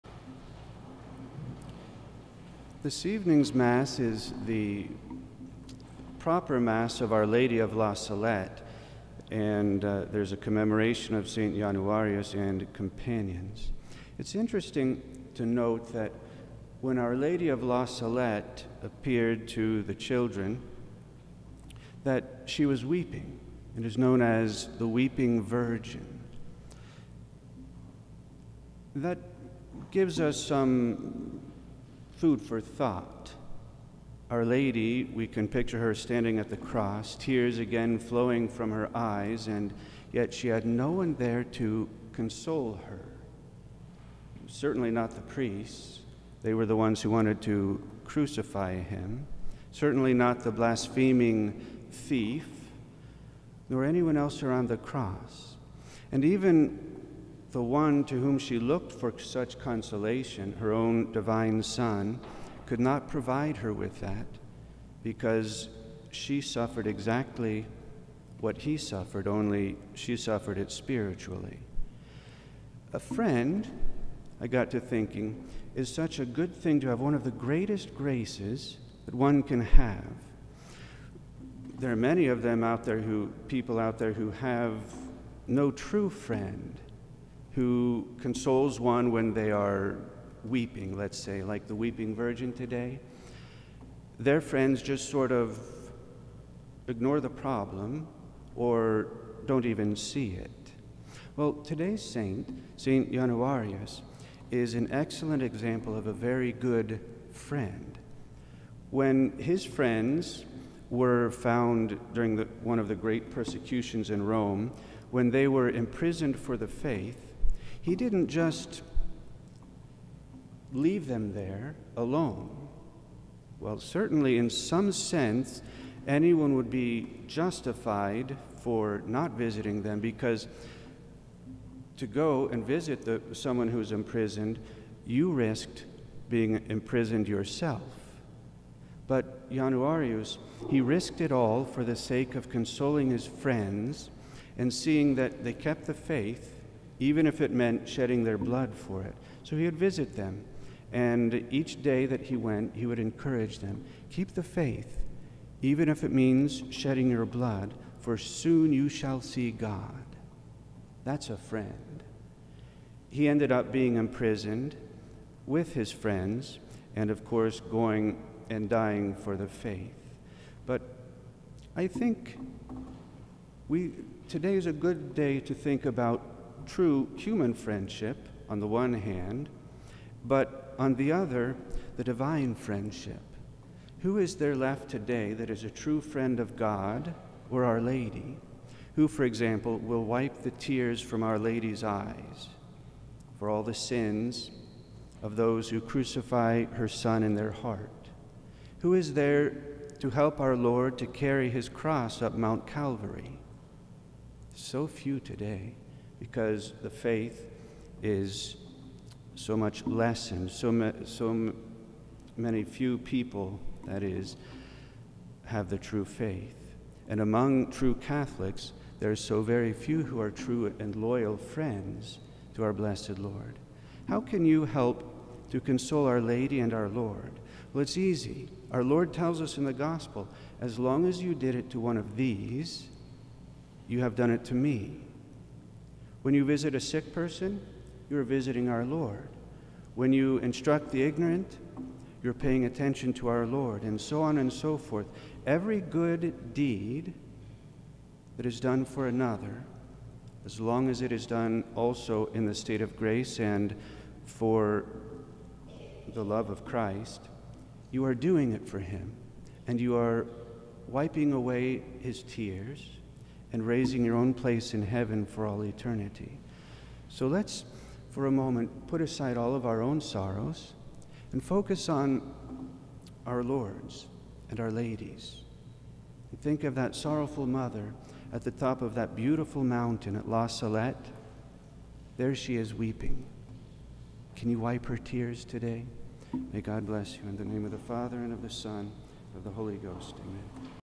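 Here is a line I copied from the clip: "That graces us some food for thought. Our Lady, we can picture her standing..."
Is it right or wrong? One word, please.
wrong.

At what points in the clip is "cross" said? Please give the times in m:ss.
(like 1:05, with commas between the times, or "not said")
0:36, 0:54, 3:21.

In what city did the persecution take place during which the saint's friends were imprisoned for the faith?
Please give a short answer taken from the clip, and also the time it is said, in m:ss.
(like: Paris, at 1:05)
Rome, at 1:54.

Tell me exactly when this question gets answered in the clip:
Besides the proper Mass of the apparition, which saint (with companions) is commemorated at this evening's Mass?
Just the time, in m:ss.
0:11.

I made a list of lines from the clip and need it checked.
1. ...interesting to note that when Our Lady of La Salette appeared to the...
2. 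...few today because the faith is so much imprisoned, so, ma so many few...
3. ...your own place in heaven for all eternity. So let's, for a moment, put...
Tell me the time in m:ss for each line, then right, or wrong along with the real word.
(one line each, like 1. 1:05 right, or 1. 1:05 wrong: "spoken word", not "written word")
1. 0:14 right
2. 3:24 wrong: "lessened", not "imprisoned"
3. 4:24 right.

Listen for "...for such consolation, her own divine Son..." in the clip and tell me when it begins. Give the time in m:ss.
0:58.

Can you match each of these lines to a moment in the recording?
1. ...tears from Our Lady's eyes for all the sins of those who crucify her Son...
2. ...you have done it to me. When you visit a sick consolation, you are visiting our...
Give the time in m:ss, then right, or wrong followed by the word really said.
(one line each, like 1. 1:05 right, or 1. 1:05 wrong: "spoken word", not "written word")
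1. 3:10 right
2. 3:53 wrong: "person", not "consolation".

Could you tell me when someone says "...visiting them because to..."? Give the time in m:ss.
2:09.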